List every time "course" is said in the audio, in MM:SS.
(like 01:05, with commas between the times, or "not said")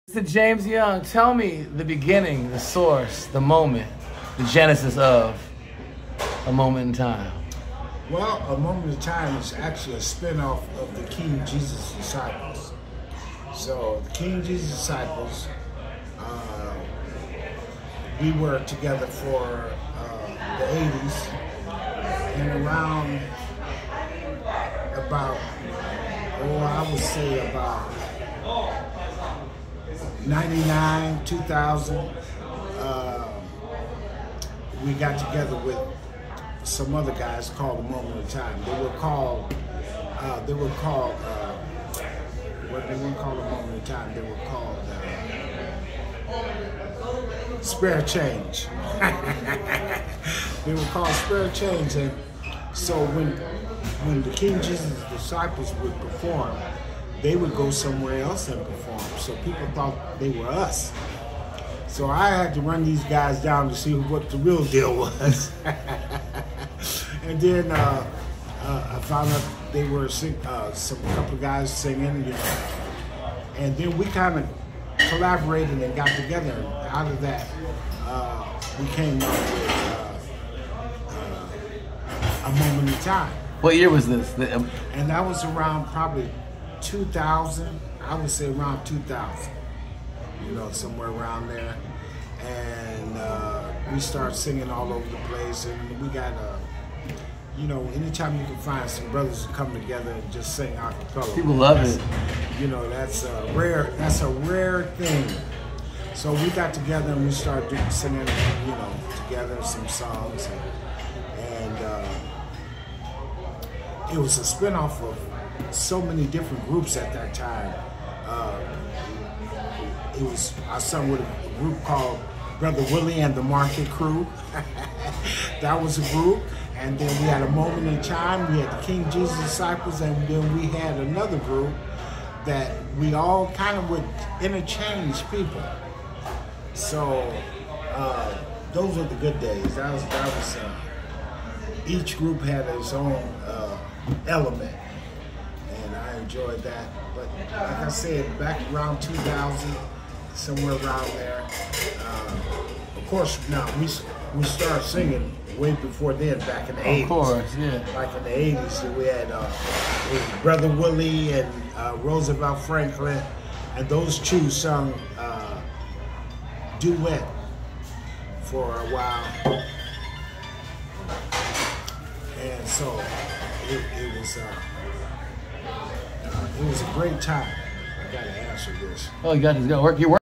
02:33, 02:37.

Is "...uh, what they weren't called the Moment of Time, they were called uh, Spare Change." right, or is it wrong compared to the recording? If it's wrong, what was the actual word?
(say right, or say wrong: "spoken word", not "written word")
right.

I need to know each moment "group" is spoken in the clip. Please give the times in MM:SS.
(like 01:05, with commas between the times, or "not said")
01:56, 02:01, 02:06, 02:11, 02:22.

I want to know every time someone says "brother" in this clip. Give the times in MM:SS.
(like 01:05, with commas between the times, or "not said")
01:39, 02:02, 02:40.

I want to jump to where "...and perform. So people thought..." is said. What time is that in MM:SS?
00:58.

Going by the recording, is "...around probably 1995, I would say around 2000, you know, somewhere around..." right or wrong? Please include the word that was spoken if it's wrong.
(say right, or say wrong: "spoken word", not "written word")
wrong: "2000", not "1995".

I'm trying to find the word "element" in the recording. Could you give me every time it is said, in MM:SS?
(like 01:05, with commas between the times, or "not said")
02:24.